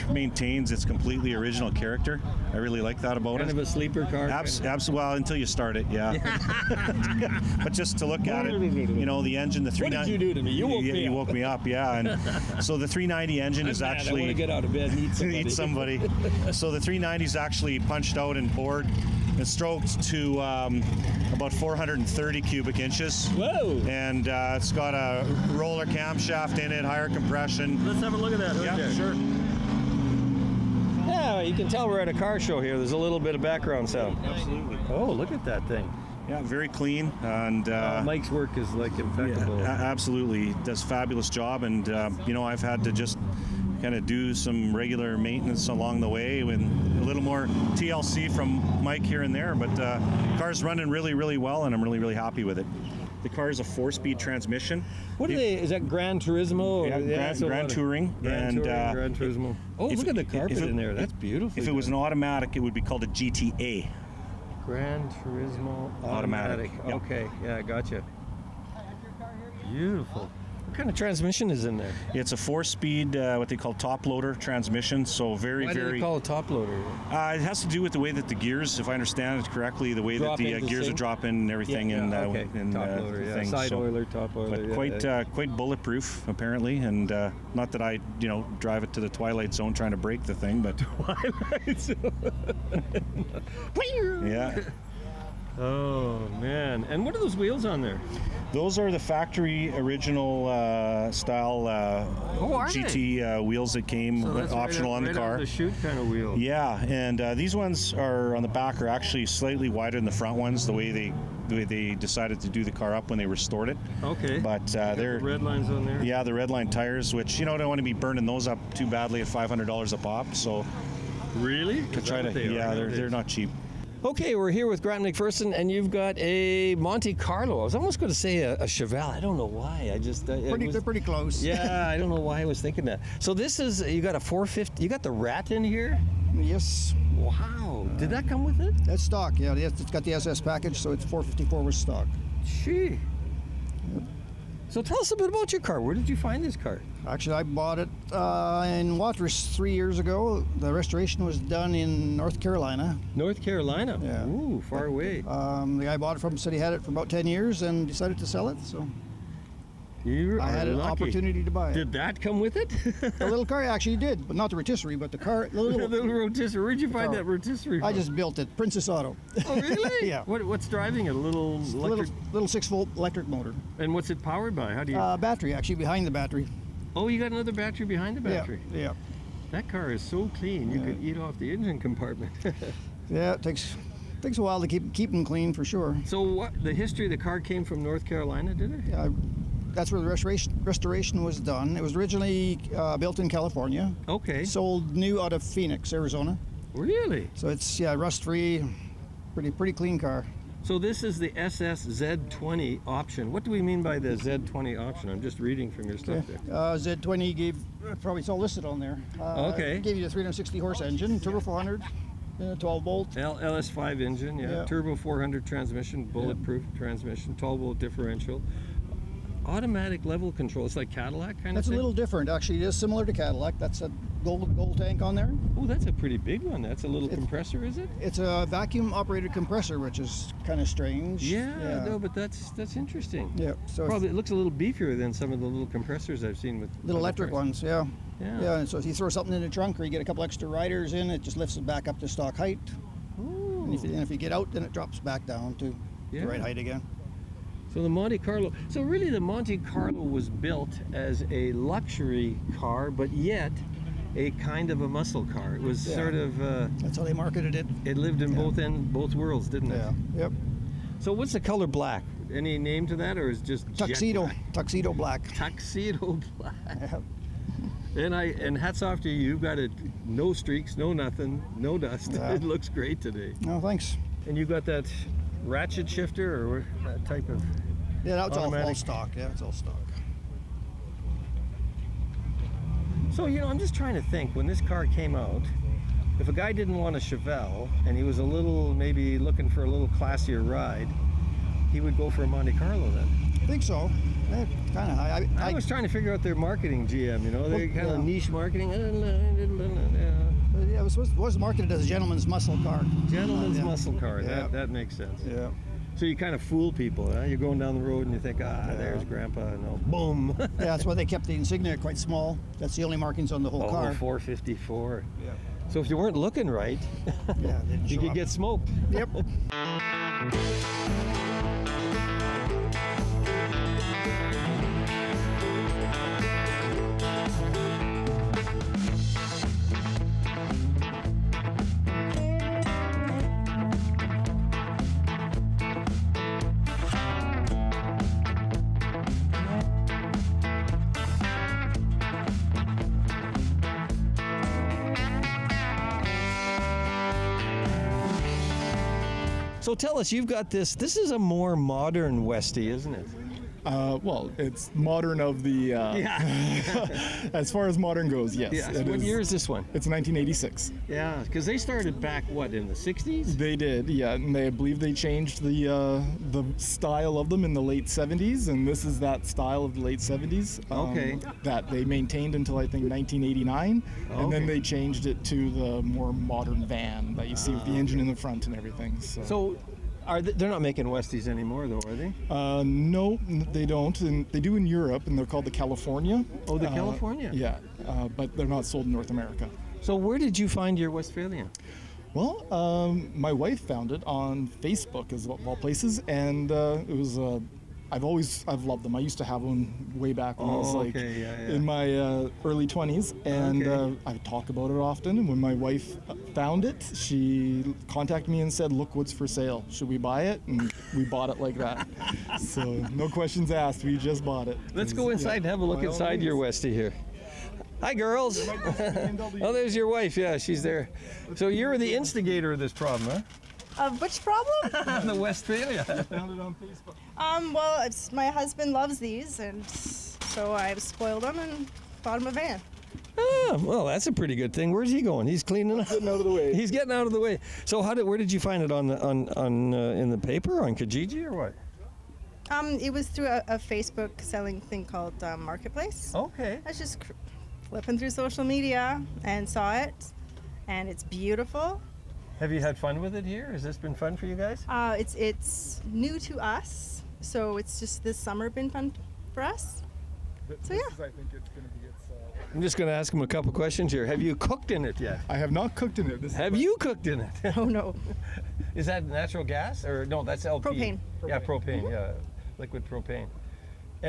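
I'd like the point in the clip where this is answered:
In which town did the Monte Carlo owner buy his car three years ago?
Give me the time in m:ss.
2:28.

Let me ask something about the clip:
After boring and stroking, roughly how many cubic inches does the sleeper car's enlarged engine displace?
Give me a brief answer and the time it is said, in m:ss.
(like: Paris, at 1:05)
430, at 0:21.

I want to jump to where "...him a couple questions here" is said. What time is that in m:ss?
7:43.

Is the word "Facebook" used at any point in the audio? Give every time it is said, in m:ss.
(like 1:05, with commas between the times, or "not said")
6:34, 7:06, 7:23.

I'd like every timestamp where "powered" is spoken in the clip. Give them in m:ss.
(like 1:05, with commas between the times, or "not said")
2:54.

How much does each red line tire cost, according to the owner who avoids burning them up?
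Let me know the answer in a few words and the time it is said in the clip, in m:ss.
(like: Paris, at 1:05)
$500, at 1:59.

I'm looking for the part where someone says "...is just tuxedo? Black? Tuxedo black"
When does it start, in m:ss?
4:23.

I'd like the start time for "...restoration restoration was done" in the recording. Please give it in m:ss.
3:10.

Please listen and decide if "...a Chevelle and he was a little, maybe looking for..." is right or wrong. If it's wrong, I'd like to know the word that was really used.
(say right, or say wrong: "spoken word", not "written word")
right.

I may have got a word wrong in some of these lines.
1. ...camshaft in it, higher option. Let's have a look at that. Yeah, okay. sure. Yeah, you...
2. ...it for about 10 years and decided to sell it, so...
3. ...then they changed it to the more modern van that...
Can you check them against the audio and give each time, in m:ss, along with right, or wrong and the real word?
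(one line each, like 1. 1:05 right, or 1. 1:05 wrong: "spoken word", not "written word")
1. 0:25 wrong: "compression", not "option"
2. 2:36 right
3. 6:14 right.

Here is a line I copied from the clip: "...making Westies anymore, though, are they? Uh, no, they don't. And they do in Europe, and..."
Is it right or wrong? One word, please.
right.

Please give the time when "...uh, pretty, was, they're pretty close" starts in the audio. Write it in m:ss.
2:10.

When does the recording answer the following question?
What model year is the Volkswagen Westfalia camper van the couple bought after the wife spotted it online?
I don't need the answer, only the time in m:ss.
5:59.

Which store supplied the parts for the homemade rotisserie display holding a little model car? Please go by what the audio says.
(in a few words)
Princess Auto.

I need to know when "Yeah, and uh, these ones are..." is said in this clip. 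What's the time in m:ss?
1:46.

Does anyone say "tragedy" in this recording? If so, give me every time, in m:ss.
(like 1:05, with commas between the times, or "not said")
not said.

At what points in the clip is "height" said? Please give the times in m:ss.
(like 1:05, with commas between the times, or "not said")
4:02, 4:06.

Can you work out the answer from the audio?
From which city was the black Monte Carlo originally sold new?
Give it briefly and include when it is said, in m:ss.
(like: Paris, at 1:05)
Phoenix, Arizona, at 3:15.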